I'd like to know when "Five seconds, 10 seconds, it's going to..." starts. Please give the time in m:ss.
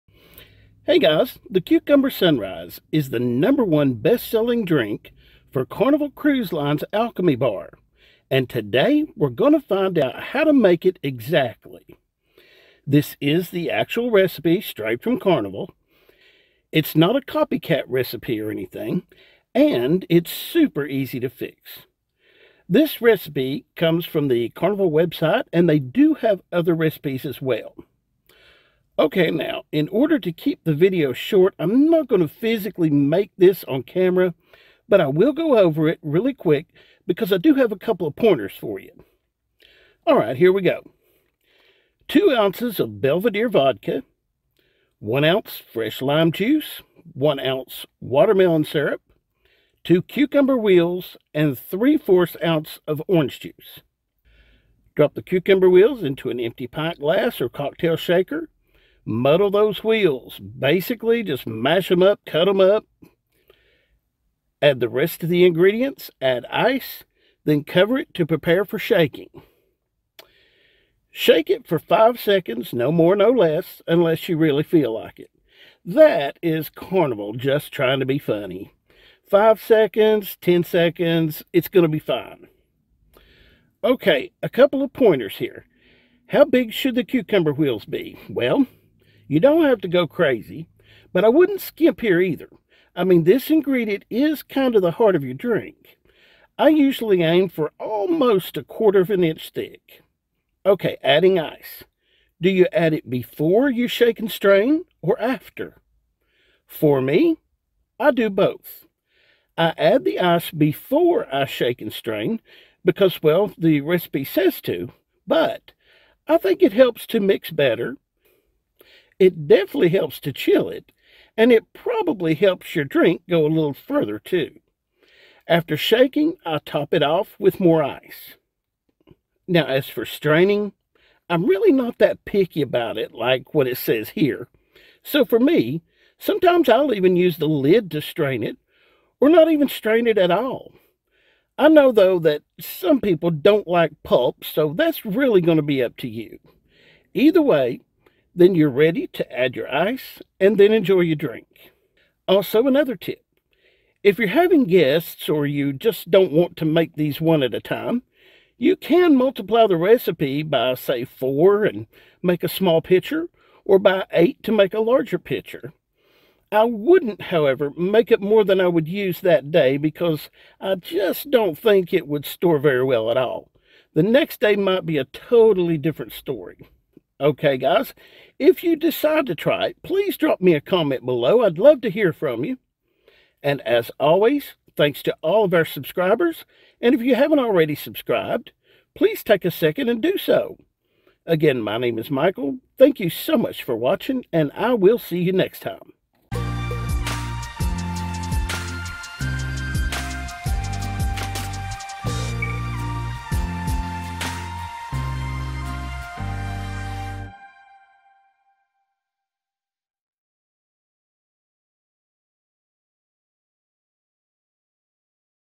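1:19.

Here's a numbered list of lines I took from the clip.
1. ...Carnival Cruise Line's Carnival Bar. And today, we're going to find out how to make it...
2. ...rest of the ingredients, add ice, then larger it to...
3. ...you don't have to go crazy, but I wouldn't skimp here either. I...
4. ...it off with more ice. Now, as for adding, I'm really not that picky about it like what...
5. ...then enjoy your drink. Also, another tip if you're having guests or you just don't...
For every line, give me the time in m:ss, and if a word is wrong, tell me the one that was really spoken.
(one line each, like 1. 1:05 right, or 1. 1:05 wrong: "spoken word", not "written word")
1. 0:05 wrong: "Alchemy", not "Carnival"
2. 1:04 wrong: "cover", not "larger"
3. 1:29 right
4. 2:06 wrong: "straining", not "adding"
5. 2:30 right.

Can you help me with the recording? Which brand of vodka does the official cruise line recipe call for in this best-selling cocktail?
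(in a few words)
Belvedere.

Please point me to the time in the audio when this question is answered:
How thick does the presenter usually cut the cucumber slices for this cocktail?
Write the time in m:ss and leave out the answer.
1:38.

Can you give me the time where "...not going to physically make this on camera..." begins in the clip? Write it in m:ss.
0:31.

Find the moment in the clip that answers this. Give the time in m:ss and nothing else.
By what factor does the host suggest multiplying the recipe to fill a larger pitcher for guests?
2:44.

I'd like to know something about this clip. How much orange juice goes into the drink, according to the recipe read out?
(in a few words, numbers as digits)
3/4 ounce.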